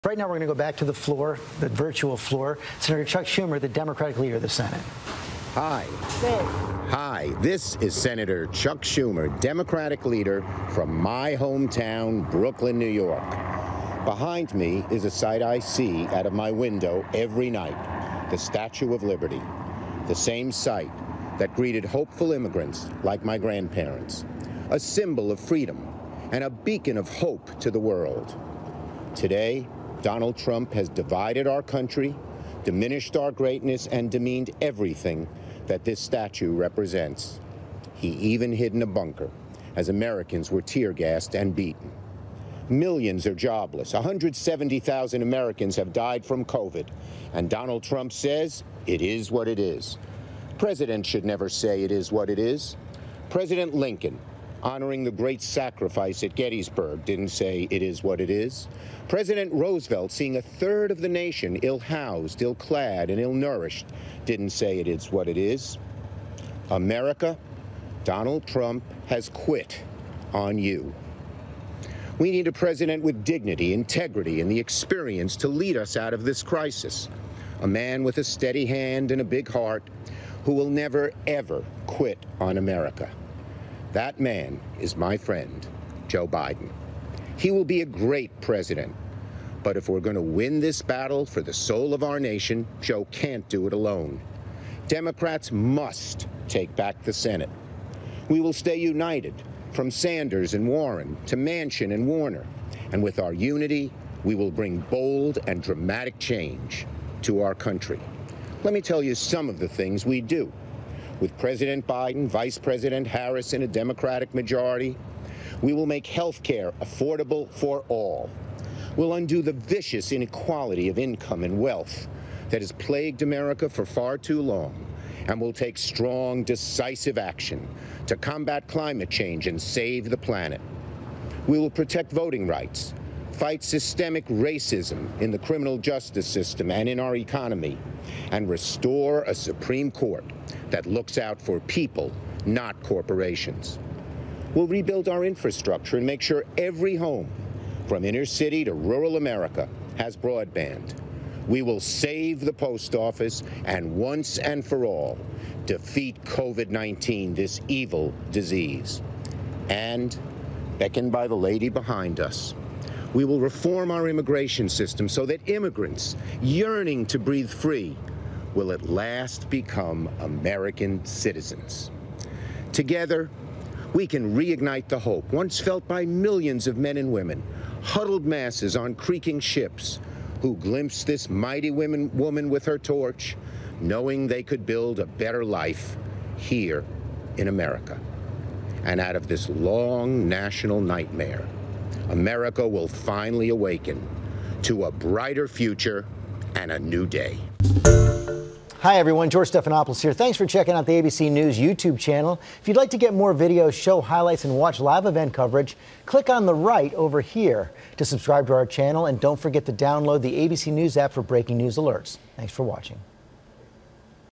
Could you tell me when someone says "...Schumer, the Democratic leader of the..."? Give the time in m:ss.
0:03.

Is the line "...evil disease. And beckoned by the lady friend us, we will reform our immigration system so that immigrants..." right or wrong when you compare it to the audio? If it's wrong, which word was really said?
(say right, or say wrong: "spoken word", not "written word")
wrong: "behind", not "friend".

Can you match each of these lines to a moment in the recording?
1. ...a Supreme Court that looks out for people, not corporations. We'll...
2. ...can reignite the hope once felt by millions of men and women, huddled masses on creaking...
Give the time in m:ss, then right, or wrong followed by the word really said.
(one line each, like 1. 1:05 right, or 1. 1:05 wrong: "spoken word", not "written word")
1. 2:19 right
2. 2:54 right.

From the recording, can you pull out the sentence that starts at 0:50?
President should never say it is what it is.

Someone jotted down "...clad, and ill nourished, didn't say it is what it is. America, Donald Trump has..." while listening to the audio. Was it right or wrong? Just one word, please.
right.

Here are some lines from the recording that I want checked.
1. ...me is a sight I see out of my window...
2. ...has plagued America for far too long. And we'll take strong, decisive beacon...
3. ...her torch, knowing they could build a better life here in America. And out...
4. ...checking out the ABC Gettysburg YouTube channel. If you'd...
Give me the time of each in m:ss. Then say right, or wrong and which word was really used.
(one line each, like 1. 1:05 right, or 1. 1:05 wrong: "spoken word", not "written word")
1. 0:14 right
2. 2:02 wrong: "action", not "beacon"
3. 3:02 right
4. 3:20 wrong: "News", not "Gettysburg".